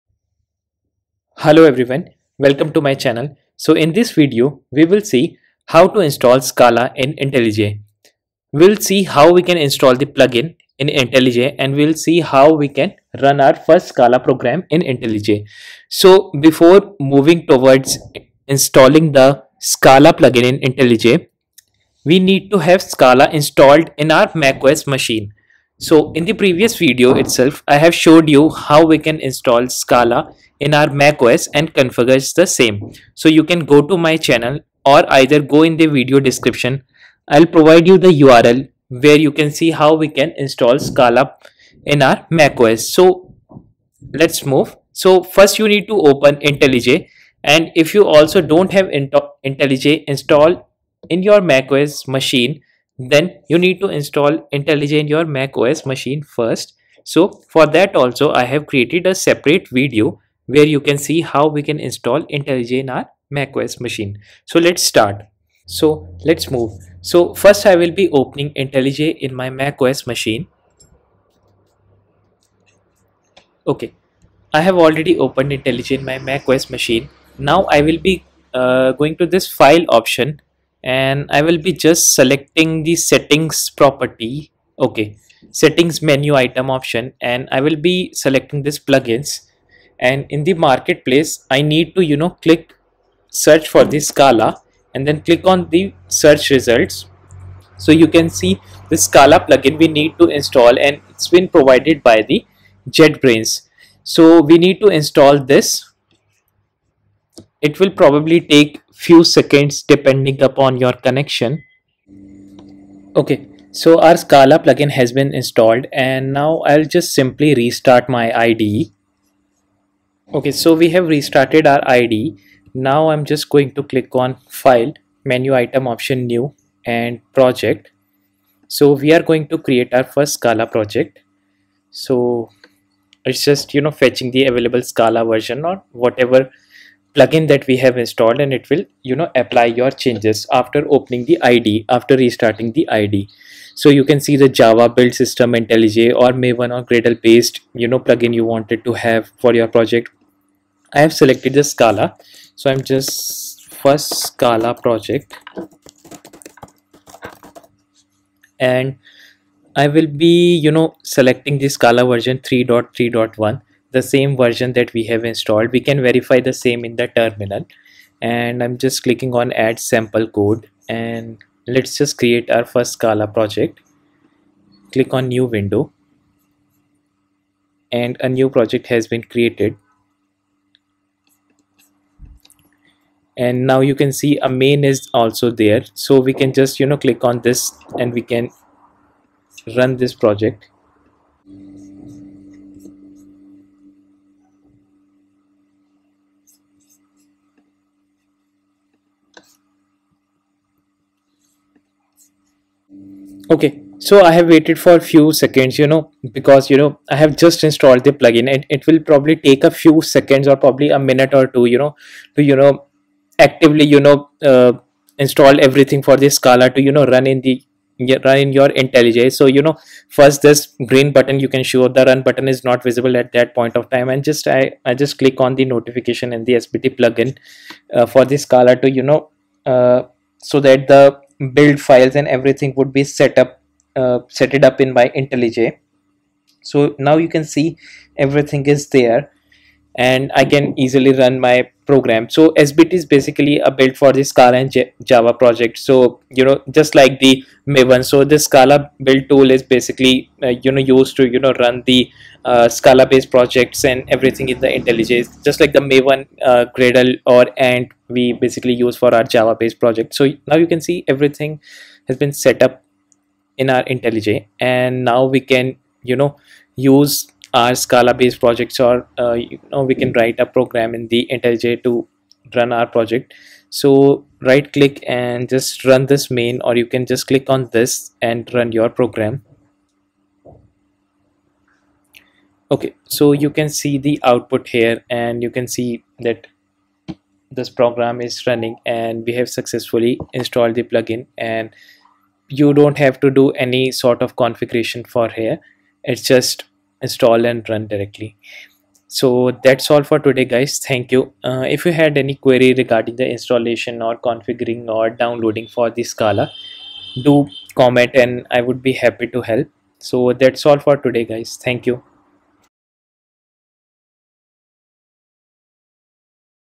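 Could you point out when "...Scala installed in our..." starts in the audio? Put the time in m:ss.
0:22.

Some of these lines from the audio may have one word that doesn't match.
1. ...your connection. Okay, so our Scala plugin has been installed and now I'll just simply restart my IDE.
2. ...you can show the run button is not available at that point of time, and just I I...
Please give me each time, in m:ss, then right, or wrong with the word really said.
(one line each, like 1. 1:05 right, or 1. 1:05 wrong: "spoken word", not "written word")
1. 1:50 right
2. 3:41 wrong: "visible", not "available".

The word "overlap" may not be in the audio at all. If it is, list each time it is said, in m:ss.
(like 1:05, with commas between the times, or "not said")
not said.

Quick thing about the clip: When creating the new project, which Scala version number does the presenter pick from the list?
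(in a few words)
3.3.1.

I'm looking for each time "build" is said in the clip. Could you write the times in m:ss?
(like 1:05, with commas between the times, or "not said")
2:24, 3:51, 4:03, 4:09.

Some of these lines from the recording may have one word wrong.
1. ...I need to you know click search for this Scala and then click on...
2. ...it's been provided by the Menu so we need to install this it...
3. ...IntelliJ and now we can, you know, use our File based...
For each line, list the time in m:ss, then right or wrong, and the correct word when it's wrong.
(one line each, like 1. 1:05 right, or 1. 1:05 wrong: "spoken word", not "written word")
1. 1:31 right
2. 1:41 wrong: "JetBrains", not "Menu"
3. 4:23 wrong: "Scala", not "File".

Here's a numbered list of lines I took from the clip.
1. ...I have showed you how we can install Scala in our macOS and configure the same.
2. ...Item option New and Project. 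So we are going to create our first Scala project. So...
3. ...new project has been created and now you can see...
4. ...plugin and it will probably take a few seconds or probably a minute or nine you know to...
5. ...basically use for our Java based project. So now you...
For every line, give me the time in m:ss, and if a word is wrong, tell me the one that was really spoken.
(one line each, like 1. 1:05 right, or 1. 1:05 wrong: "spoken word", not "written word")
1. 0:27 right
2. 2:05 right
3. 2:58 right
4. 3:28 wrong: "two", not "nine"
5. 4:18 right.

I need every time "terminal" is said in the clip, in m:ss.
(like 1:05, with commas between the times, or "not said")
2:47.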